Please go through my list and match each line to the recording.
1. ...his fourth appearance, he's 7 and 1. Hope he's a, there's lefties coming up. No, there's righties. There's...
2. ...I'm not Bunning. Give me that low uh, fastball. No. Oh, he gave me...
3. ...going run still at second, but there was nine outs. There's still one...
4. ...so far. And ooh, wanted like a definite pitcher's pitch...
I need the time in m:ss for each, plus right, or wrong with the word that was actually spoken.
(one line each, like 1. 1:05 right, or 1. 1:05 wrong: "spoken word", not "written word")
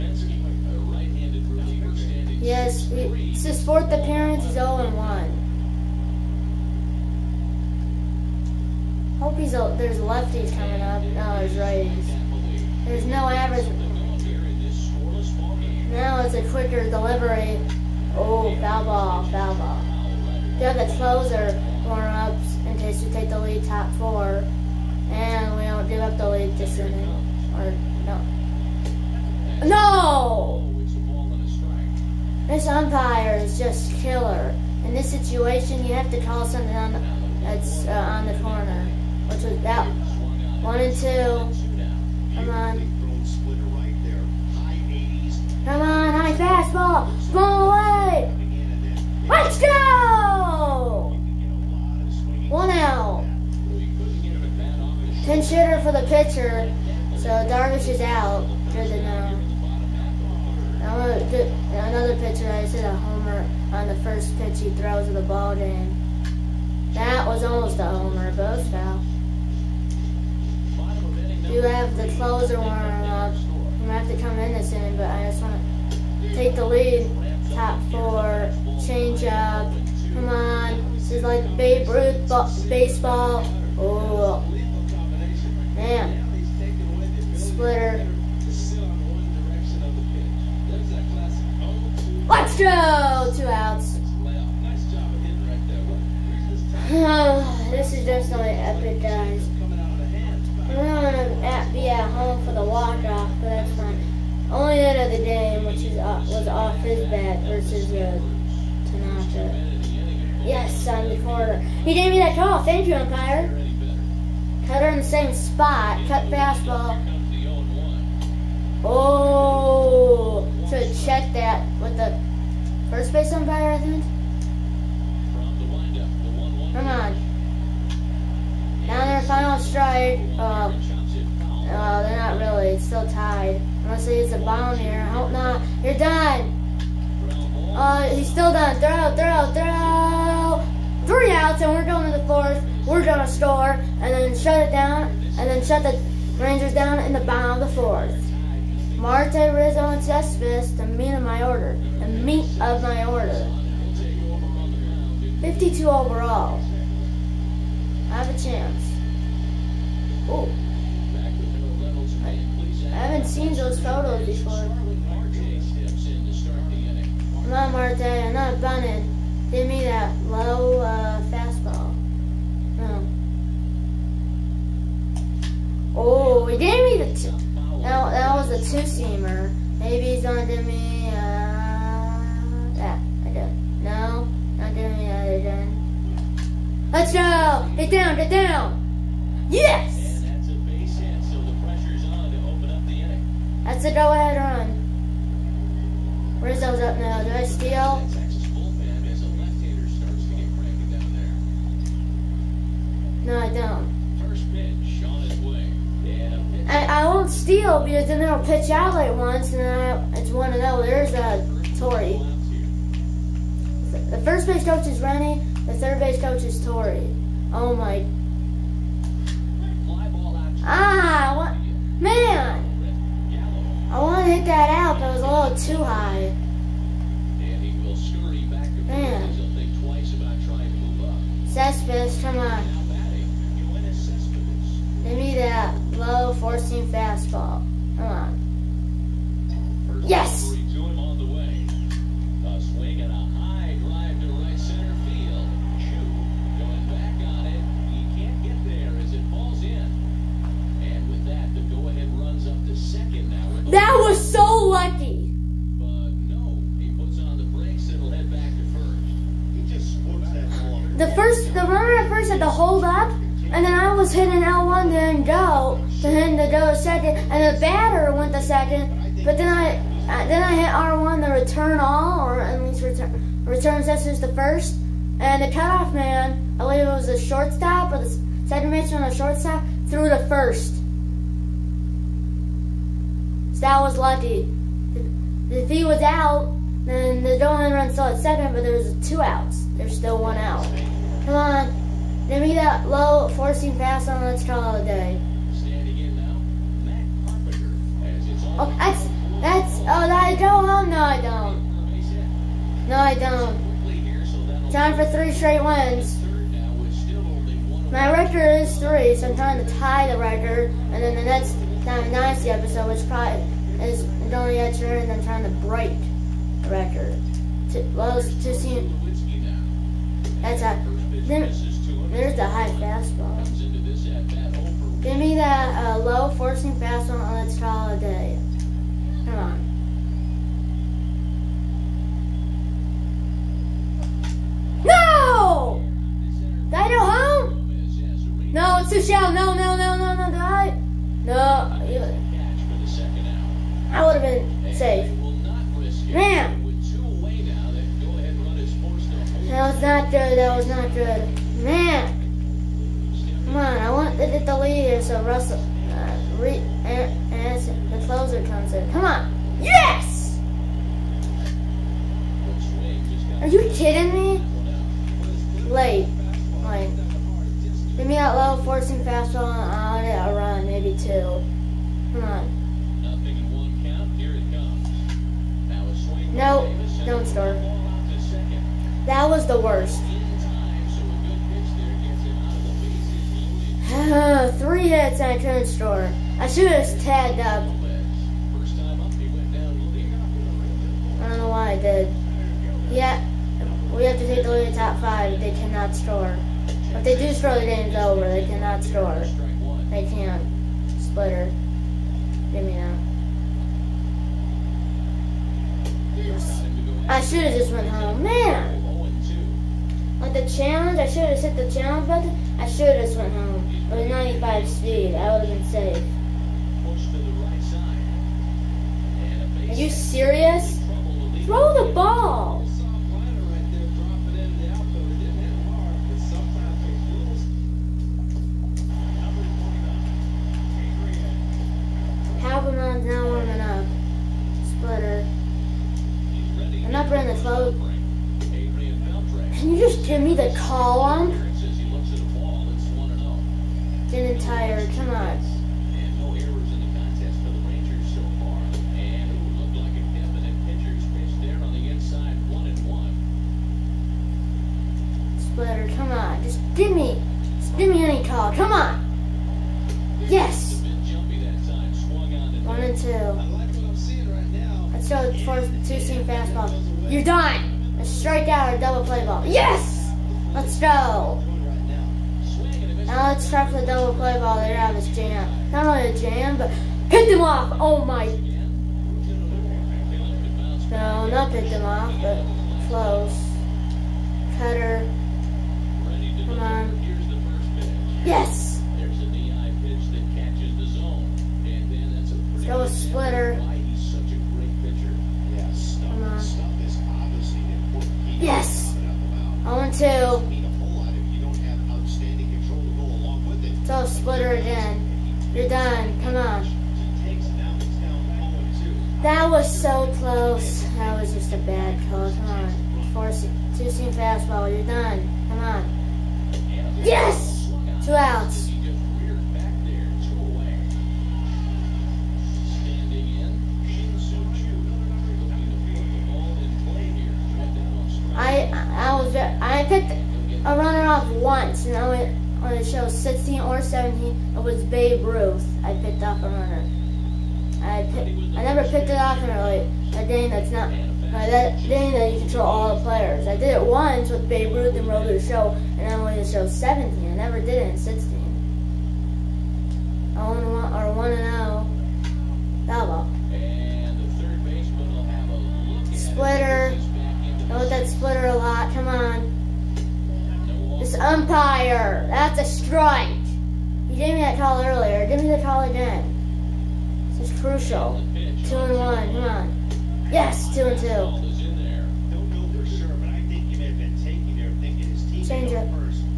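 1. 0:03 wrong: "0", not "7"
2. 2:48 right
3. 4:47 wrong: "two", not "nine"
4. 7:28 wrong: "looked", not "wanted".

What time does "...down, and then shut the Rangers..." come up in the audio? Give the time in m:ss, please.
2:24.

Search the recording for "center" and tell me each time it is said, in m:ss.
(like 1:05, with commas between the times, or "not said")
4:04, 4:38.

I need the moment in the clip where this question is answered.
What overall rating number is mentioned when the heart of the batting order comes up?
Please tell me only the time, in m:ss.
2:35.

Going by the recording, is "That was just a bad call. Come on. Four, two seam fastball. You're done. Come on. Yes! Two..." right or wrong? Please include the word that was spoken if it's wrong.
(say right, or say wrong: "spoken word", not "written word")
right.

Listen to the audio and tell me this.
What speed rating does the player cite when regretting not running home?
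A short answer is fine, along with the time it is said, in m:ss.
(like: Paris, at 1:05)
95, at 6:54.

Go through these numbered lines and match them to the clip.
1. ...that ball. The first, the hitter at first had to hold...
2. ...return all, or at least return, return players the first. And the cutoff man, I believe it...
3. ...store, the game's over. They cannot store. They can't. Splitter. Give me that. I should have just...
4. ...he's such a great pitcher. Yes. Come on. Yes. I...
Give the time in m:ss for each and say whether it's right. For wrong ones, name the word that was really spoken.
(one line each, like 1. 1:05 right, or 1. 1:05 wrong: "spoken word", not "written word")
1. 4:20 wrong: "runner", not "hitter"
2. 4:31 wrong: "sensors", not "players"
3. 6:37 right
4. 8:13 right.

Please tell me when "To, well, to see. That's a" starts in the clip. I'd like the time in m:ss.
5:17.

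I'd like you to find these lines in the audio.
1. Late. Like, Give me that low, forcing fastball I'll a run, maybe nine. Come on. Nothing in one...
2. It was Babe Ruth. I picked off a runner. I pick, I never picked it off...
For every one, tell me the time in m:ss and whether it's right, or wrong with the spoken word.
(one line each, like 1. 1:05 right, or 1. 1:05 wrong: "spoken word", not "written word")
1. 6:05 wrong: "two", not "nine"
2. 8:54 right.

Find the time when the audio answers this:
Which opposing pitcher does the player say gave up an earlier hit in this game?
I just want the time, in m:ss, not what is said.
1:48.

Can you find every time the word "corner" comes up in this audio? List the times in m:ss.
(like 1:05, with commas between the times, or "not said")
0:38, 1:51.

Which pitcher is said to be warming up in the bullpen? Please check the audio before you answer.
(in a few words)
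Halberman.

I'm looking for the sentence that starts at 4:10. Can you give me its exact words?
And with that, the go-ahead runs up to second now.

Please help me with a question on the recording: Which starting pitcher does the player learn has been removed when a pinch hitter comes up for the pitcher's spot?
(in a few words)
Darvish.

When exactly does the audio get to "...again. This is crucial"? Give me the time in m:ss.
9:25.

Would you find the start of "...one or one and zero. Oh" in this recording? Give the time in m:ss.
9:10.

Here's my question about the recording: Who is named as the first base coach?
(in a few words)
Rennie.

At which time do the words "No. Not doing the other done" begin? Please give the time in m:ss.
3:03.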